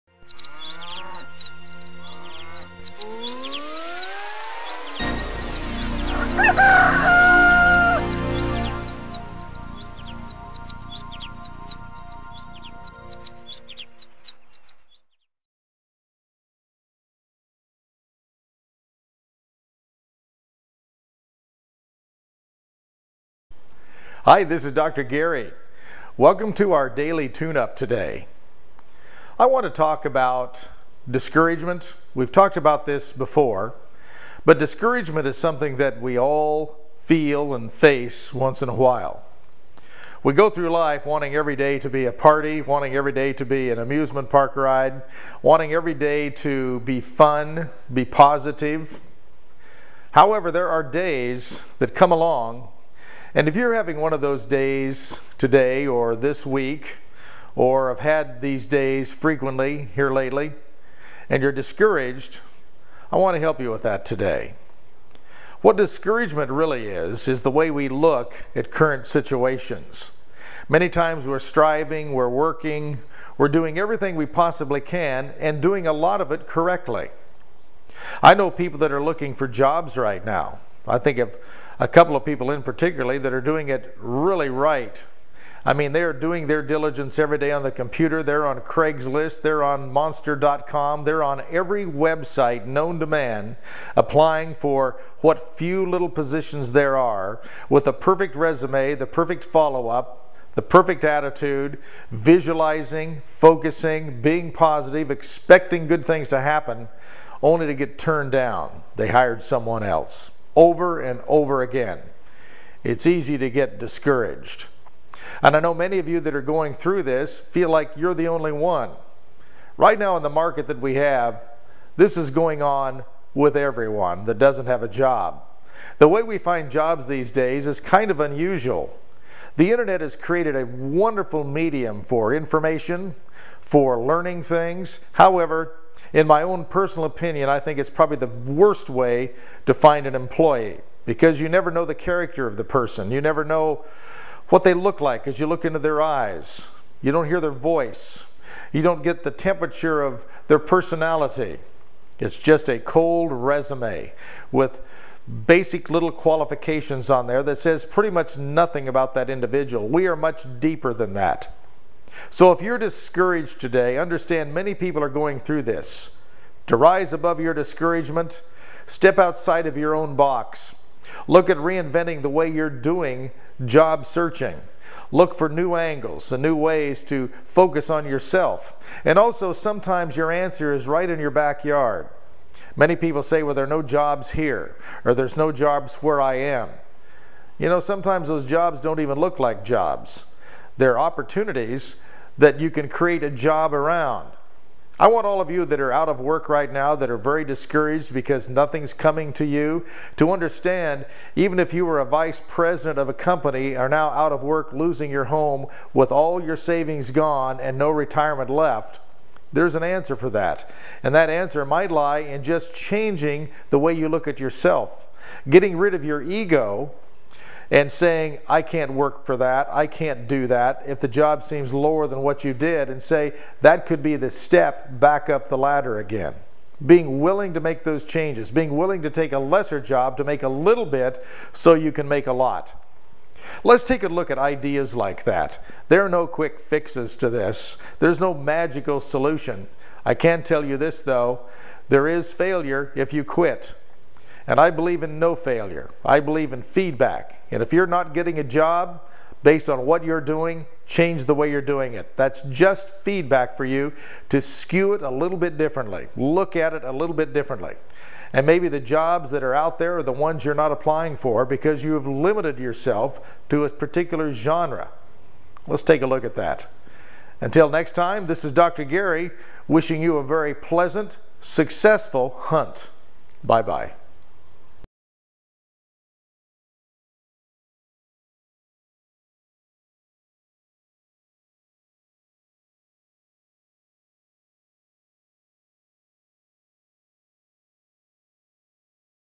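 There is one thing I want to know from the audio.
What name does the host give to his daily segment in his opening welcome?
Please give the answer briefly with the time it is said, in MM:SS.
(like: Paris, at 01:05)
daily tune up, at 00:26.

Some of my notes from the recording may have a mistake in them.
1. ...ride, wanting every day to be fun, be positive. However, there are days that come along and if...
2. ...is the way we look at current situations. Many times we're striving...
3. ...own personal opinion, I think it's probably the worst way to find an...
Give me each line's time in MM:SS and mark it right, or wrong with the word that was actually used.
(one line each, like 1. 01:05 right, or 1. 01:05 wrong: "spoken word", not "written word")
1. 00:44 right
2. 01:07 right
3. 02:16 right.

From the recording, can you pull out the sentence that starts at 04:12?
That's just feedback for you to skew it a little bit differently, look at it a little bit differently.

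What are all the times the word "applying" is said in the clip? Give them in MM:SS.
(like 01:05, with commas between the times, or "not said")
01:33, 04:20.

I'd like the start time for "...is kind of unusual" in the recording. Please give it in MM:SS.
02:07.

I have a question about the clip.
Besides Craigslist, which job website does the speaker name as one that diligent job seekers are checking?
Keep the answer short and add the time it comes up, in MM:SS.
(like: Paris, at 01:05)
monster.com, at 01:29.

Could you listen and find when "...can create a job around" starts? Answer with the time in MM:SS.
03:12.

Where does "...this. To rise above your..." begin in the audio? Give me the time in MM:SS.
02:45.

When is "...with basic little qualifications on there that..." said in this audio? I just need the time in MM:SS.
02:34.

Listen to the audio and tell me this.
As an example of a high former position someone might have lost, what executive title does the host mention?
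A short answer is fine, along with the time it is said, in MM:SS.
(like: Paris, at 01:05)
vice president, at 03:22.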